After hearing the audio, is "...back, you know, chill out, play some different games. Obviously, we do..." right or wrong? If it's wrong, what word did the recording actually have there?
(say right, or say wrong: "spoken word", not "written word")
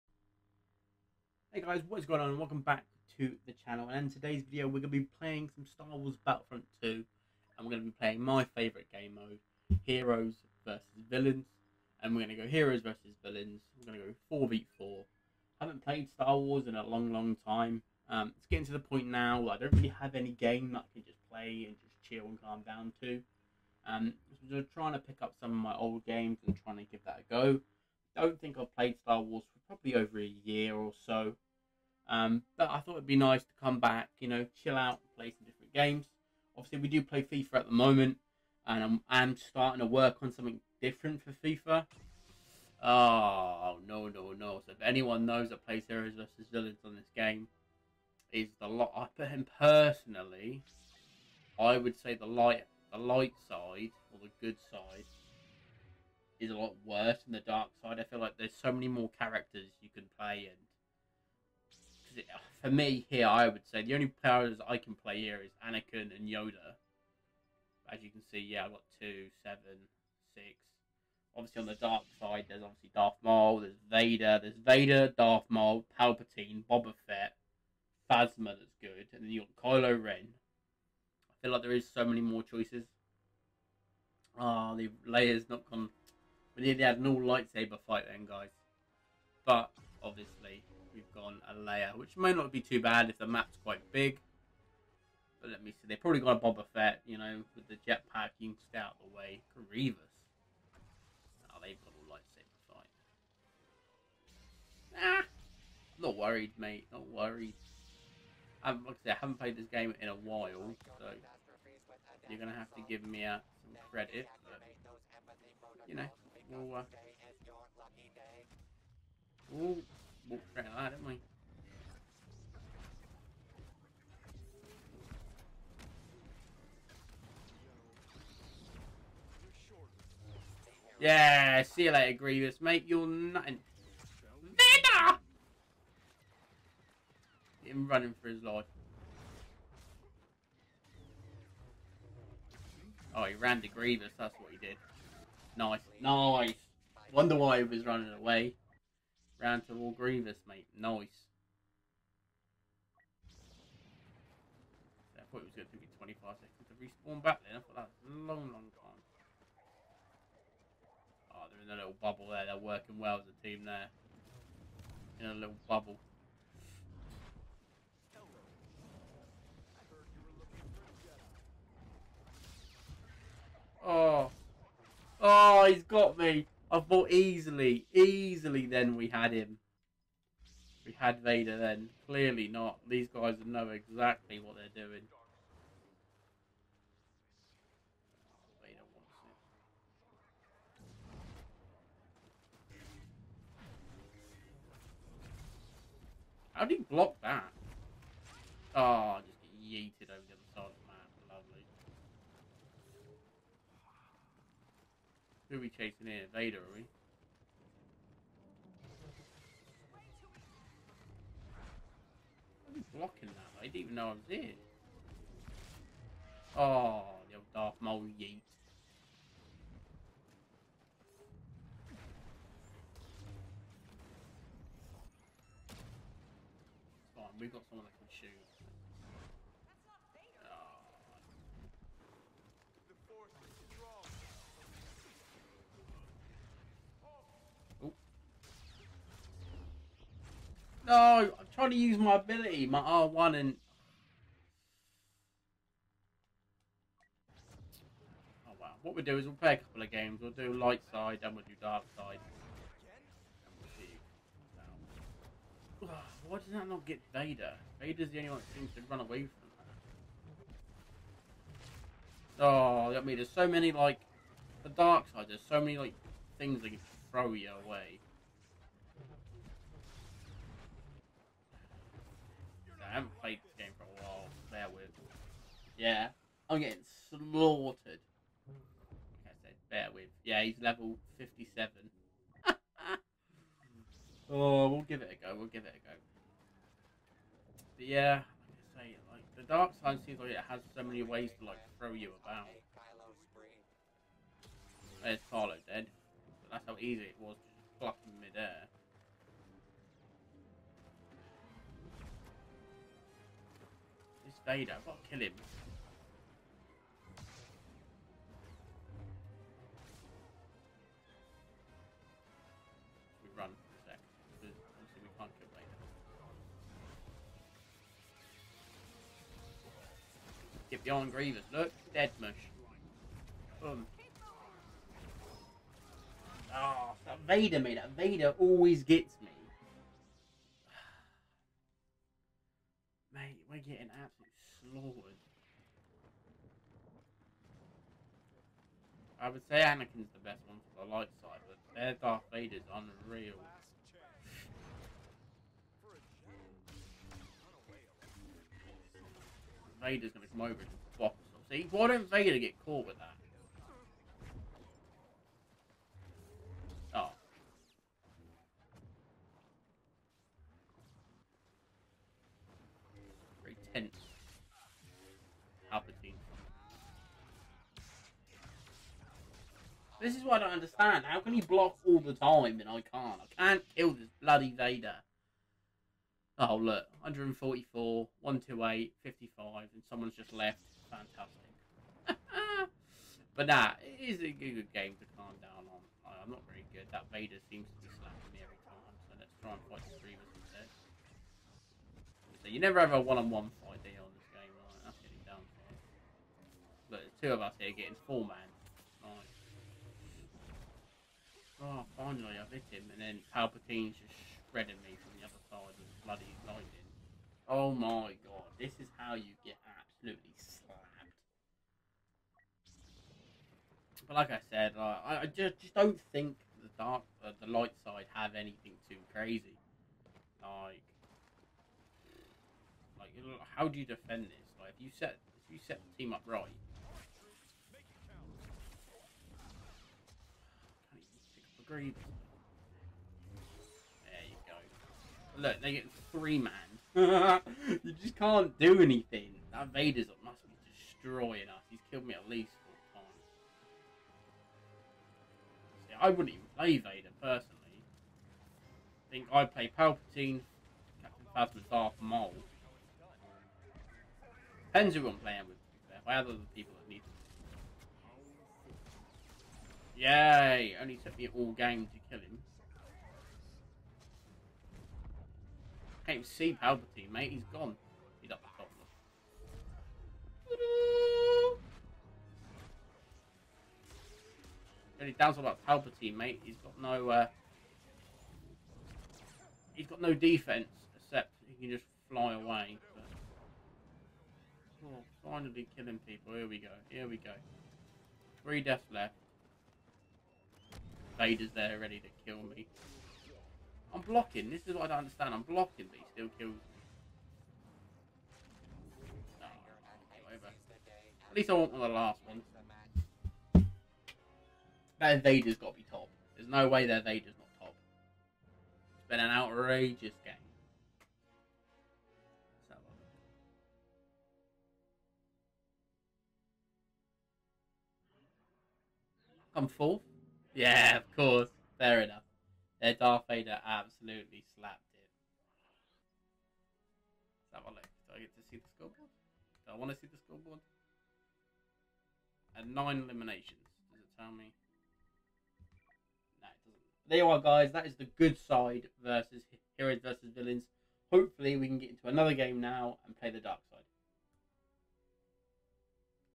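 right.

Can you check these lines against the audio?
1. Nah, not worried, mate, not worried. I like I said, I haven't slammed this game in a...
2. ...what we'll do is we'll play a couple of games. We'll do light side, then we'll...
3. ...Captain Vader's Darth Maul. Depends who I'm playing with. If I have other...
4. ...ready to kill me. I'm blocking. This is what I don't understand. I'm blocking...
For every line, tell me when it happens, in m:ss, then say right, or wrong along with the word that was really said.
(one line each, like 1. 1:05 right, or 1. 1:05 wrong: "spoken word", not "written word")
1. 1:46 wrong: "played", not "slammed"
2. 4:08 right
3. 7:31 wrong: "Phasma", not "Vader"
4. 8:11 right.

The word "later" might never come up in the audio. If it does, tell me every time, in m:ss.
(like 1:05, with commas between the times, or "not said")
2:11.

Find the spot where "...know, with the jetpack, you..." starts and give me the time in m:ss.
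1:37.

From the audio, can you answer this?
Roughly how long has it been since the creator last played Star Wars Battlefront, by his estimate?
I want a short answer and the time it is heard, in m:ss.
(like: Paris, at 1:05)
Over a year, at 0:29.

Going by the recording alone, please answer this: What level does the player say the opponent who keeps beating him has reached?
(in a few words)
57.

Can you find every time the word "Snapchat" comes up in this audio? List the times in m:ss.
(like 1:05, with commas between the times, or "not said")
not said.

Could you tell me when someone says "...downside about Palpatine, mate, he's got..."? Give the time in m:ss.
7:55.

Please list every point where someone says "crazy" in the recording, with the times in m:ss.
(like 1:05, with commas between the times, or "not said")
6:59.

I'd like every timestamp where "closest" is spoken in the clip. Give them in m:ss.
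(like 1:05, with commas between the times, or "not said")
not said.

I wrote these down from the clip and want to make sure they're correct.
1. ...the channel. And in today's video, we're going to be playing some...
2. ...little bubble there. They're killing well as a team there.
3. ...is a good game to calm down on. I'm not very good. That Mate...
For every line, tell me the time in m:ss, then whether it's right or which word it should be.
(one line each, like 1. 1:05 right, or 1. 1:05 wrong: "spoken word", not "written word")
1. 0:03 right
2. 2:41 wrong: "working", not "killing"
3. 6:24 wrong: "Vader", not "Mate".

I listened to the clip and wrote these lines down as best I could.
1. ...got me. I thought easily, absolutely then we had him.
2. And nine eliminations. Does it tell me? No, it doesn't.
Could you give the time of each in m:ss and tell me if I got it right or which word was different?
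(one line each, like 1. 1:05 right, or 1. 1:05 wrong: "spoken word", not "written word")
1. 2:55 wrong: "easily", not "absolutely"
2. 8:52 right.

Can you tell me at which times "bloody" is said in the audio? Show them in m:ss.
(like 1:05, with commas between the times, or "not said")
6:14, 6:46.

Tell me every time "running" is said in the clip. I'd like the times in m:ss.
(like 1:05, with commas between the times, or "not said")
2:17, 2:27.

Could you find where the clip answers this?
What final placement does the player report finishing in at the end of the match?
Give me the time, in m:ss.
8:39.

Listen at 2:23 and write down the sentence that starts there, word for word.
Oh, he ran to Grievous, that's what he did.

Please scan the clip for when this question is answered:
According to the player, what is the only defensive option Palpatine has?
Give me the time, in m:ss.
8:02.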